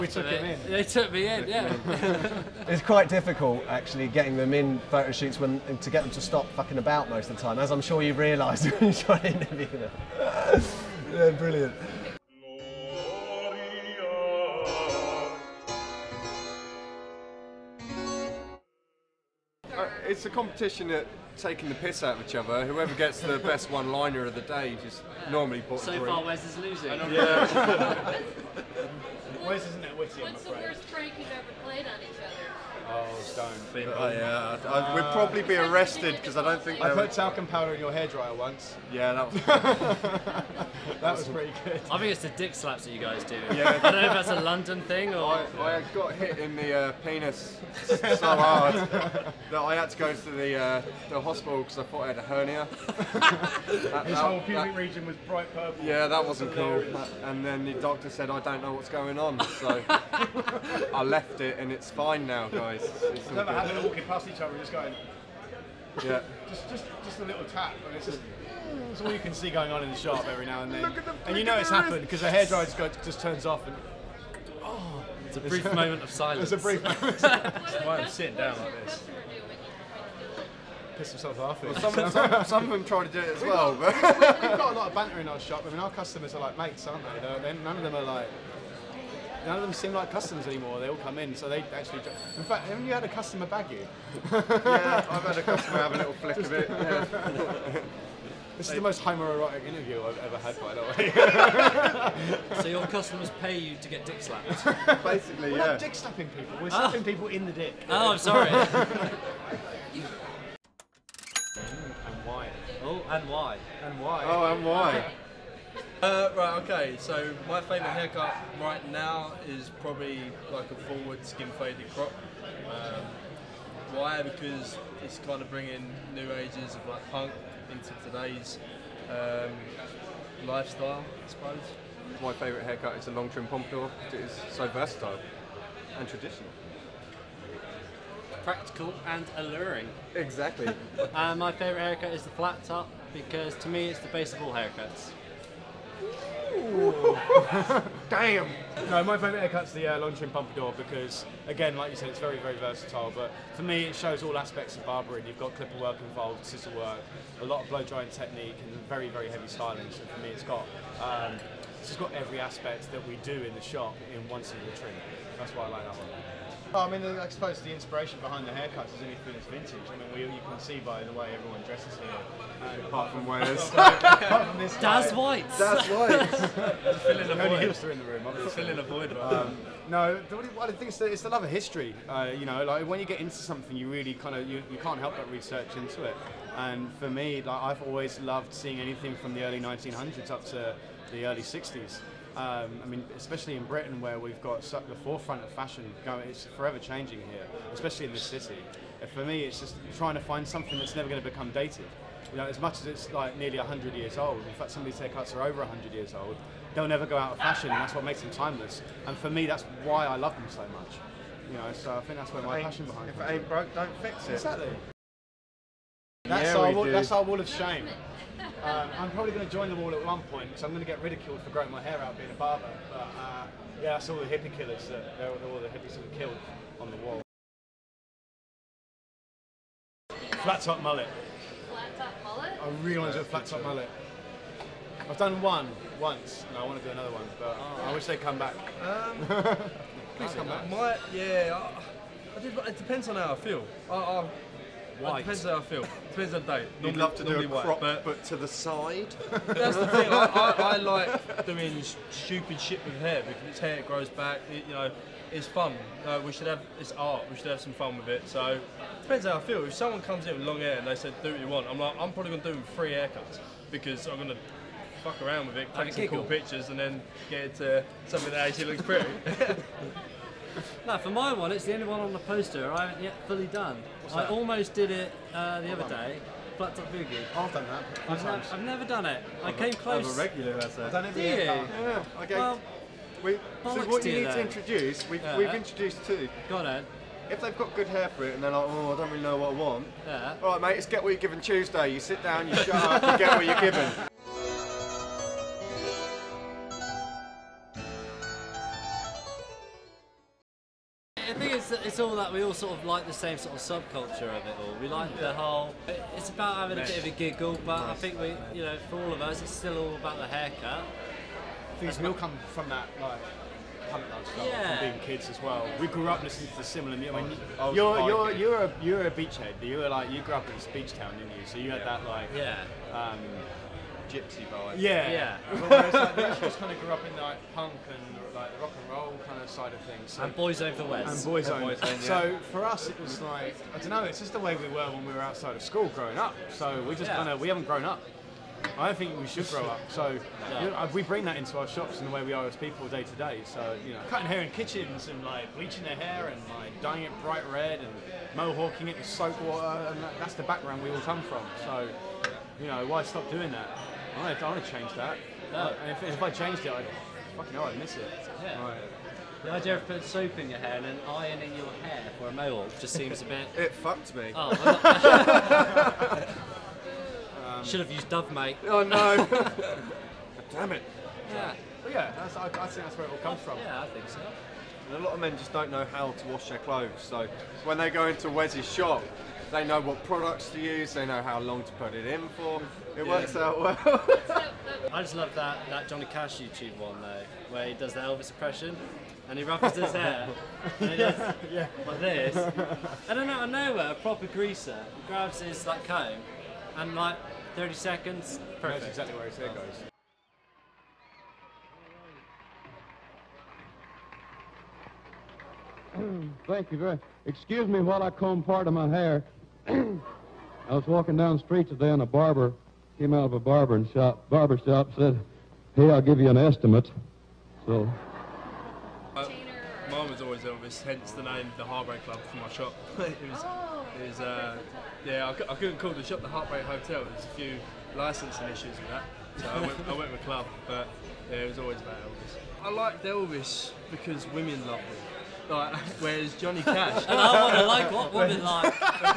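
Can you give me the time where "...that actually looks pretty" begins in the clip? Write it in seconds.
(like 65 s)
268 s.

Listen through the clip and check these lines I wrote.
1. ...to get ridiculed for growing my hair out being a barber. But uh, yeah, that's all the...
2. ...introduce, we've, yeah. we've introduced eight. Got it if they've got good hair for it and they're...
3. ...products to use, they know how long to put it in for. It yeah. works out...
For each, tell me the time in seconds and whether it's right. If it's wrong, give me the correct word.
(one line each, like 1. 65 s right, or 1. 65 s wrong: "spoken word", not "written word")
1. 220 s right
2. 284 s wrong: "two", not "eight"
3. 380 s right.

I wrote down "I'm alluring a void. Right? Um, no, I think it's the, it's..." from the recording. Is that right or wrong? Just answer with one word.
wrong.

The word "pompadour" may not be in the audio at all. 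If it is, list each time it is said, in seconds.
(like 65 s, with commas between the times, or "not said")
133 s, 150 s.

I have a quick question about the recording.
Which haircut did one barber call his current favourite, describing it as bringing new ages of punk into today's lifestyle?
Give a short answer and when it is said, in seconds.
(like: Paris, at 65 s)
Skin faded crop, at 121 s.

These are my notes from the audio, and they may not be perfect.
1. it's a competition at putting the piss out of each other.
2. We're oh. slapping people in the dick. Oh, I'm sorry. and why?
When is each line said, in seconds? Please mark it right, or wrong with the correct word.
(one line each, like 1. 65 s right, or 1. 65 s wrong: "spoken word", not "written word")
1. 20 s wrong: "taking", not "putting"
2. 106 s right.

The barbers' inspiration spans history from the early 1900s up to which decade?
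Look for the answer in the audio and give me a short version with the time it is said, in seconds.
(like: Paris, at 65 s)
Early 60s, at 191 s.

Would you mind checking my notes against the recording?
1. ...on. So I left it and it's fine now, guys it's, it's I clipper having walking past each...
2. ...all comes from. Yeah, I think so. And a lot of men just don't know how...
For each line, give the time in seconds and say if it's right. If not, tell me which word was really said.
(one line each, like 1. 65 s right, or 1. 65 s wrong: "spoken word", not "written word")
1. 59 s wrong: "remember", not "clipper"
2. 373 s right.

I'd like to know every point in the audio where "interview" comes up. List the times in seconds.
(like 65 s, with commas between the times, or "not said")
9 s, 99 s.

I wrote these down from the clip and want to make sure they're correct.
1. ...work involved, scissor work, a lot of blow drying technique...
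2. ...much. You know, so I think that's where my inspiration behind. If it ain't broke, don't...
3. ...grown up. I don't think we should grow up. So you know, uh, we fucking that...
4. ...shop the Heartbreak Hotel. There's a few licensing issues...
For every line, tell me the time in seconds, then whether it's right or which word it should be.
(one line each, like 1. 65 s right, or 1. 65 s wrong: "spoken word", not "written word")
1. 155 s right
2. 210 s wrong: "passion", not "inspiration"
3. 337 s wrong: "bring", not "fucking"
4. 426 s right.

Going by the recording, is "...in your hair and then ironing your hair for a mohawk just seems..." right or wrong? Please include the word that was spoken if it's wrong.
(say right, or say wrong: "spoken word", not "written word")
right.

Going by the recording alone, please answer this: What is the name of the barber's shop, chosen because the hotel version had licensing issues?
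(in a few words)
The Heartbreak Club.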